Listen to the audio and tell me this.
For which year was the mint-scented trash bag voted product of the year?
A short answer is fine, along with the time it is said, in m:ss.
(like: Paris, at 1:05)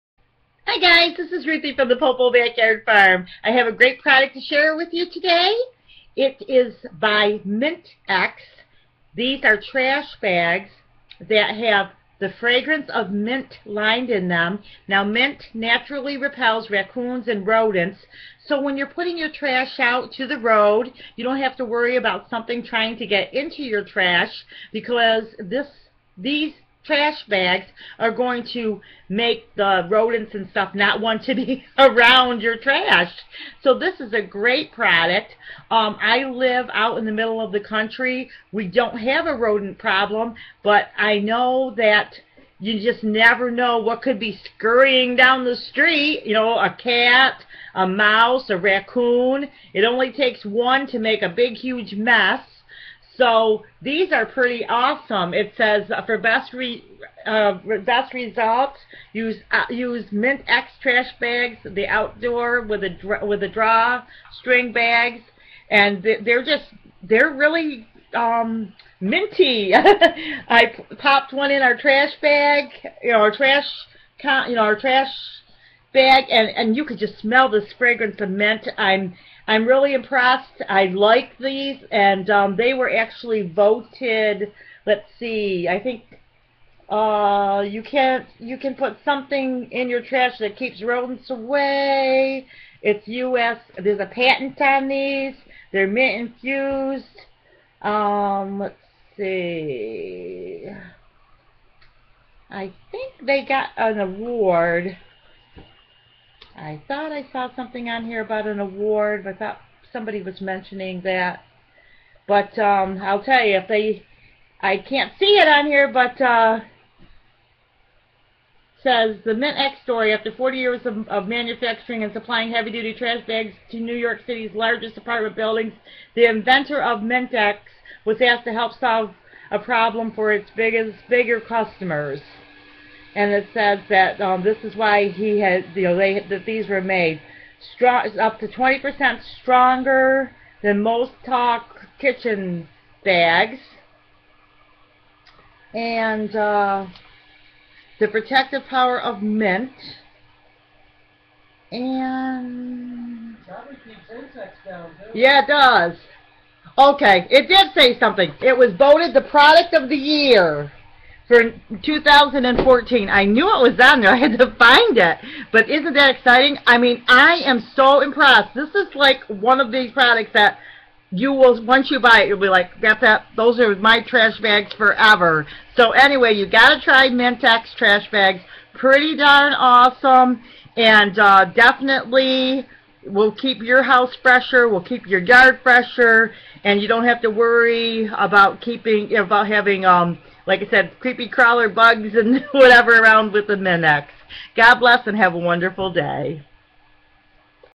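2014, at 2:41.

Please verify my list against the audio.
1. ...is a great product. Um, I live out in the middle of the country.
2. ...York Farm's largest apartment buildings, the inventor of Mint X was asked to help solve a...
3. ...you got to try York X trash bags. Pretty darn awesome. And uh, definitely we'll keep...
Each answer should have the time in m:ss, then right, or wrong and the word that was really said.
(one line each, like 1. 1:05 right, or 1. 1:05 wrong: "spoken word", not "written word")
1. 0:33 right
2. 2:03 wrong: "City", not "Farm"
3. 2:56 wrong: "Mint", not "York".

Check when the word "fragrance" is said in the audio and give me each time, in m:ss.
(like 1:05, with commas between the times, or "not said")
0:12, 1:17.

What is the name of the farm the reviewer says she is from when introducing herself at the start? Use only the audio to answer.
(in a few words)
Pople Backyard Farm.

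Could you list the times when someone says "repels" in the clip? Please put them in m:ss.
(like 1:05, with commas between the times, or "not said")
0:16.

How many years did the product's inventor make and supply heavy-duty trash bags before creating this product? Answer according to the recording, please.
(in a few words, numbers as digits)
40.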